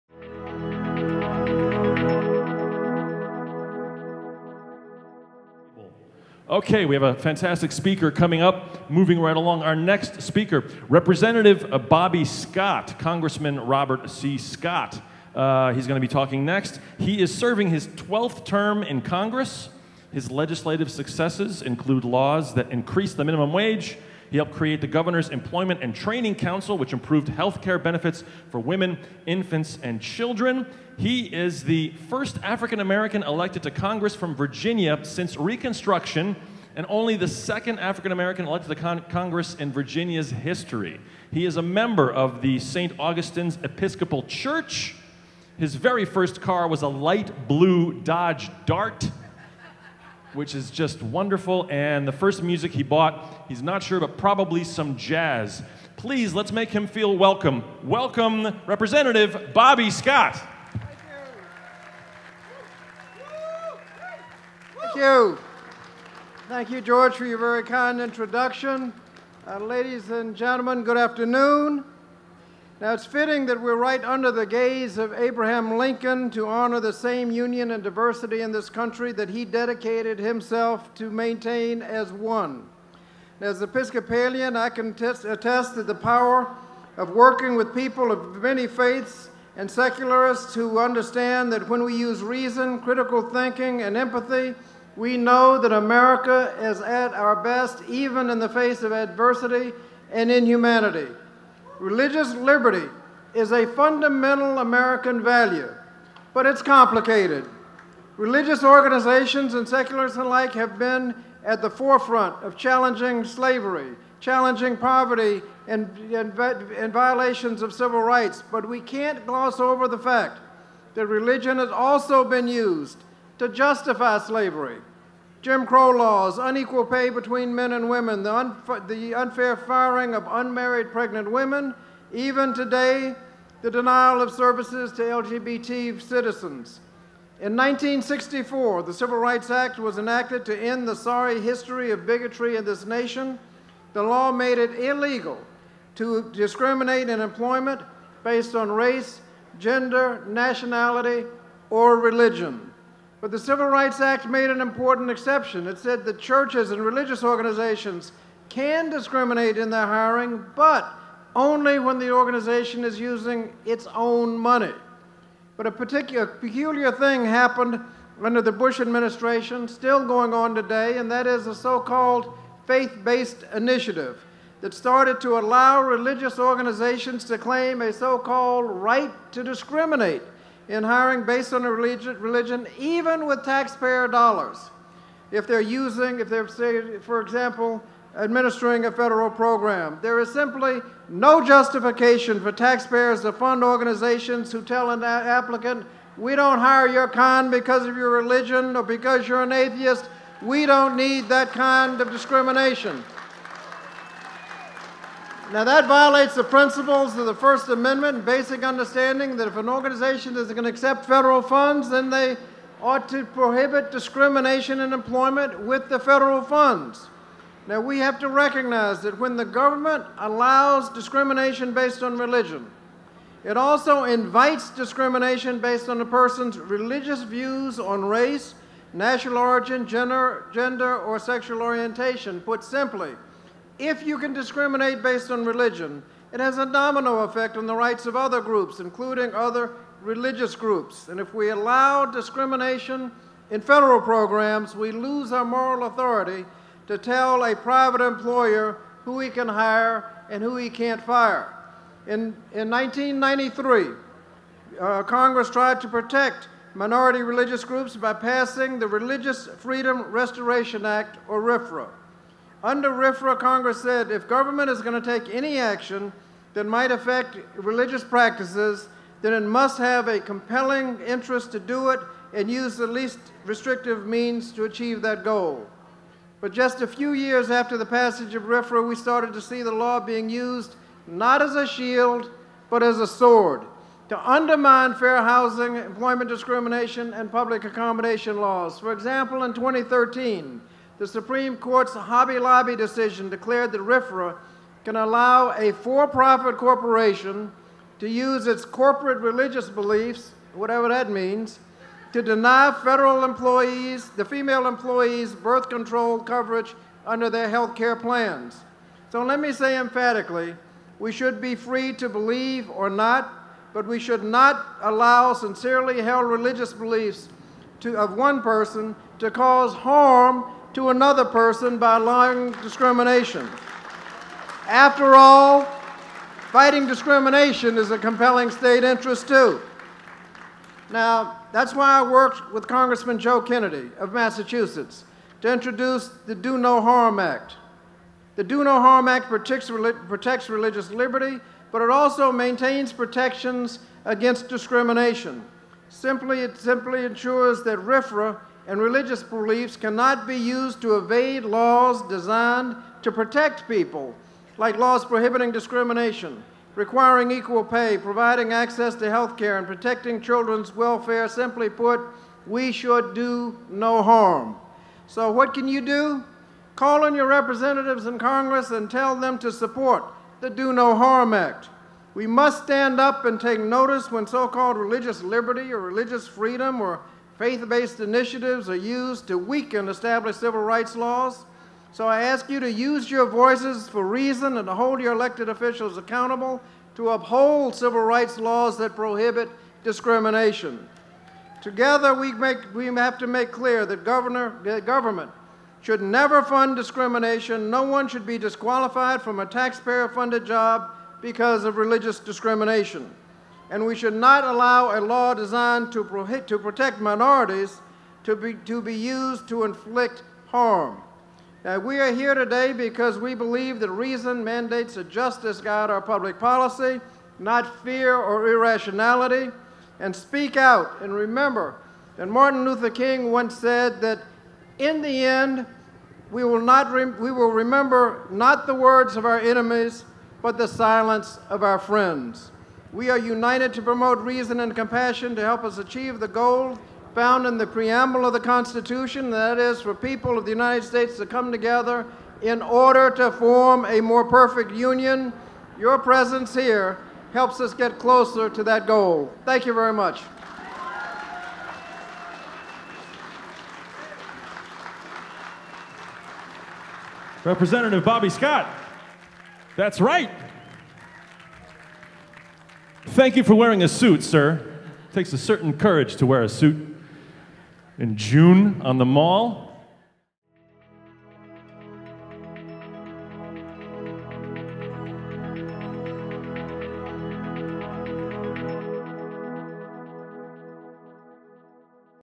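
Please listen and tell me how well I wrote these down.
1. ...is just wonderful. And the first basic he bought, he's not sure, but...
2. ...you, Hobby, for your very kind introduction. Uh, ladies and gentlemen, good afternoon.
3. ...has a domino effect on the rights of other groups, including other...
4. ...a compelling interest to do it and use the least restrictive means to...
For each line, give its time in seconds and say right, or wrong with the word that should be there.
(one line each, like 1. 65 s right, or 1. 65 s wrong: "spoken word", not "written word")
1. 50 s wrong: "music", not "basic"
2. 66 s wrong: "George", not "Hobby"
3. 236 s right
4. 270 s right.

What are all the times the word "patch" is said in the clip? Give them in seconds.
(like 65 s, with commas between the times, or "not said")
not said.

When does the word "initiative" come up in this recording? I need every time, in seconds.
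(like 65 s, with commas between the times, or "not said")
173 s, 378 s.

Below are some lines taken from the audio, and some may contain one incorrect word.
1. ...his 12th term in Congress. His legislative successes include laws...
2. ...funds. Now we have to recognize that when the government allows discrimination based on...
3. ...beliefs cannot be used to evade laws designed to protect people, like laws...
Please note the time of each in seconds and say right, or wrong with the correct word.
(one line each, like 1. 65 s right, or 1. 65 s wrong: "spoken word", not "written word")
1. 17 s right
2. 216 s right
3. 349 s right.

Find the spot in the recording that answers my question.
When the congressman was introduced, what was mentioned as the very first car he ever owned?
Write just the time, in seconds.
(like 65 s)
46 s.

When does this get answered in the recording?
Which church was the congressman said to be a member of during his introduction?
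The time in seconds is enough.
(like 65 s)
42 s.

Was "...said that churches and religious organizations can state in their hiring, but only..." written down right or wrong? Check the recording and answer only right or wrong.
wrong.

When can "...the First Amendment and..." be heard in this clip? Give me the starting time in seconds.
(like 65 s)
207 s.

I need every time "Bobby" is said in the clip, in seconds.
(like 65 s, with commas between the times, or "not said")
11 s, 59 s, 458 s.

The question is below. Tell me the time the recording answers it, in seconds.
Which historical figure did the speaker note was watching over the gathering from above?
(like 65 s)
75 s.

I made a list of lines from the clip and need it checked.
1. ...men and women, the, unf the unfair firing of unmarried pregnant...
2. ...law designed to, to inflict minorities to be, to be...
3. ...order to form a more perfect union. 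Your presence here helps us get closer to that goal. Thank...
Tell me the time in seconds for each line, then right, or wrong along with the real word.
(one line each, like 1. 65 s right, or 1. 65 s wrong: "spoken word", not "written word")
1. 127 s right
2. 404 s wrong: "protect", not "inflict"
3. 442 s right.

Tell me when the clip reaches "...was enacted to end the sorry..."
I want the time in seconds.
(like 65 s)
139 s.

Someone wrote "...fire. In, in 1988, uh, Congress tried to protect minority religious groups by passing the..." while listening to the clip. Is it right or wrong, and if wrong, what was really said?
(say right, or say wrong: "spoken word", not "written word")
wrong: "1993", not "1988".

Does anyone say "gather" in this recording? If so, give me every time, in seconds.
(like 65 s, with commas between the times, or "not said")
not said.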